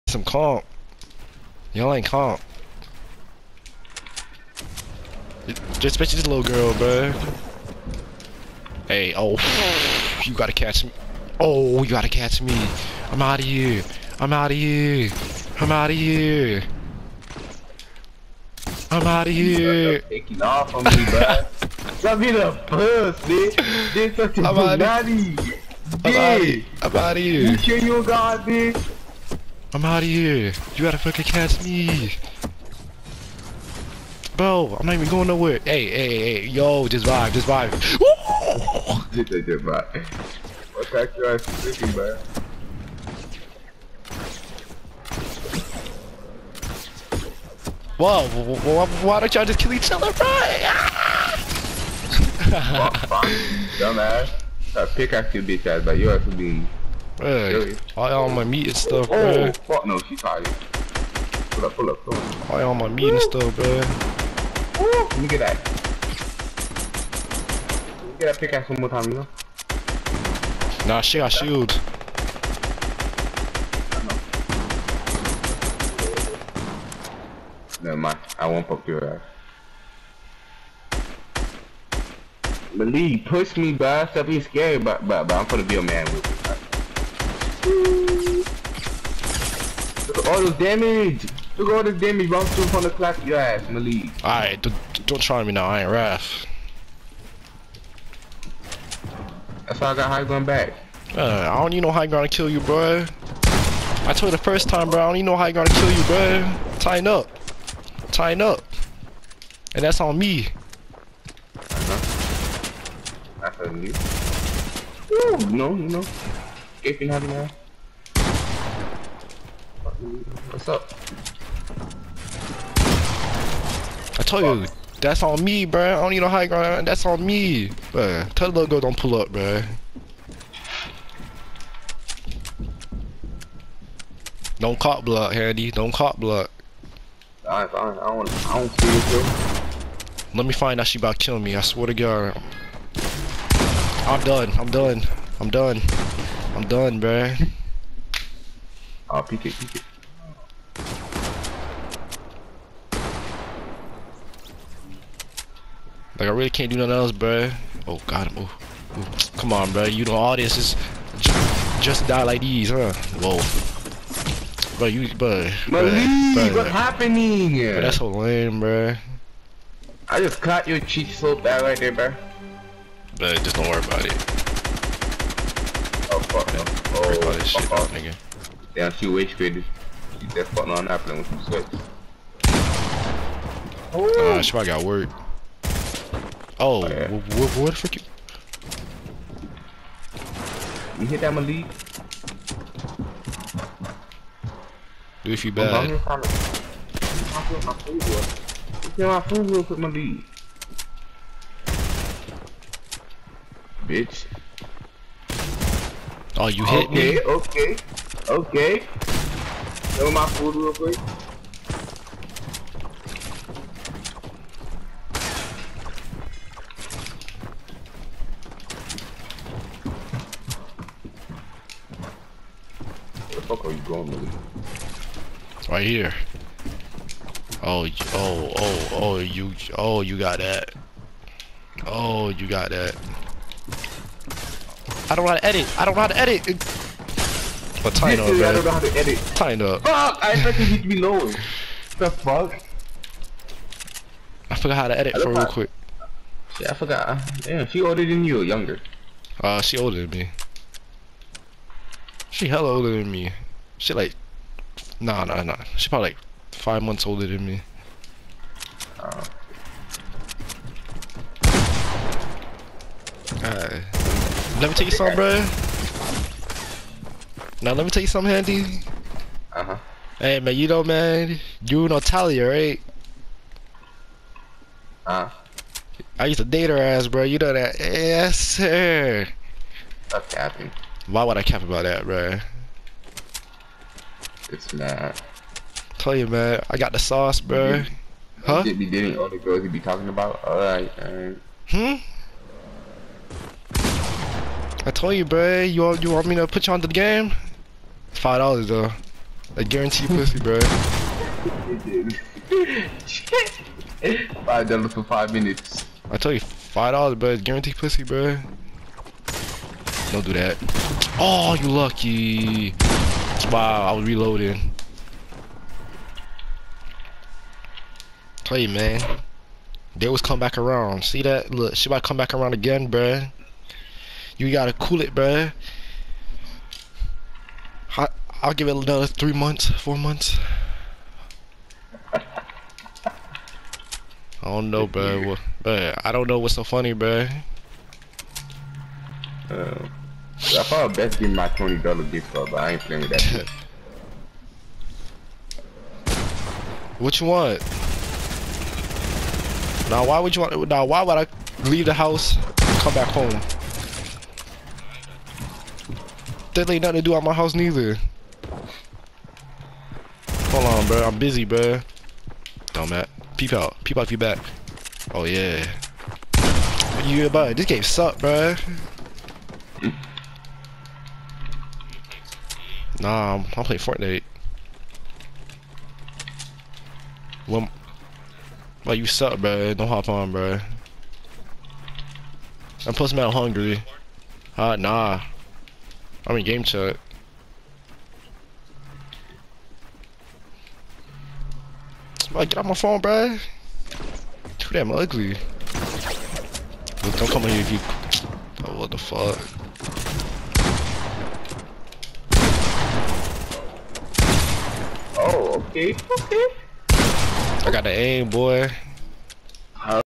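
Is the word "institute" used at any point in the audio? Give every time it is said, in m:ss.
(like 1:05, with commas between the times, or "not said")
not said.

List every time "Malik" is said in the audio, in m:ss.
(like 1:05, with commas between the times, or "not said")
1:22, 1:33, 2:45, 3:11.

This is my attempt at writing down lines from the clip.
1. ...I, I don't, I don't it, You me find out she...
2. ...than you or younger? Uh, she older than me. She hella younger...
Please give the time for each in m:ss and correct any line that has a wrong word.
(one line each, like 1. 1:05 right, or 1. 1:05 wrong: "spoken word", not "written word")
1. 2:17 wrong: "Let", not "You"
2. 4:08 wrong: "older", not "younger".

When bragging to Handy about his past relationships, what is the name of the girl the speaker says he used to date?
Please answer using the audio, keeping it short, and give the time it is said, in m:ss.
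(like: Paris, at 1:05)
Talia, at 4:31.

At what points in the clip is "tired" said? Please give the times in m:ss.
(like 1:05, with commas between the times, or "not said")
1:00.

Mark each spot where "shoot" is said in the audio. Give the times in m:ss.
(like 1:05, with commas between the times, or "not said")
2:58.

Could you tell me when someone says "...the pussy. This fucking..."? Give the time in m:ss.
0:22.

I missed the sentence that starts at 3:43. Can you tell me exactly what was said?
Where the fuck are you going, buddy?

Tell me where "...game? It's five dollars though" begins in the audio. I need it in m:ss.
4:56.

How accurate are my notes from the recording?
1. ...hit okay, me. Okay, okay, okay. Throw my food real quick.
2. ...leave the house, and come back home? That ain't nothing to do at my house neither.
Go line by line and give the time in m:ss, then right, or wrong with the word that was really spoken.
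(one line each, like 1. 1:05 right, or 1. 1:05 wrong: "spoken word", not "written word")
1. 3:26 right
2. 5:51 right.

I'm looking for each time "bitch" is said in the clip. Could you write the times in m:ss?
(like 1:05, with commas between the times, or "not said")
0:28, 0:55, 3:23.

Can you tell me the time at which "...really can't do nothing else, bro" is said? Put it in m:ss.
2:36.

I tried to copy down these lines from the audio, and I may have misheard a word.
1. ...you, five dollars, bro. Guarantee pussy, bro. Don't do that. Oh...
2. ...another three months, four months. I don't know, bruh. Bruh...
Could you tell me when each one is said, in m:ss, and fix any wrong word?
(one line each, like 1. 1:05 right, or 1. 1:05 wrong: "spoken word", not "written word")
1. 5:06 right
2. 5:28 right.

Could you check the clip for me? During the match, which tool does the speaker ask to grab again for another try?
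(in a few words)
pickaxe.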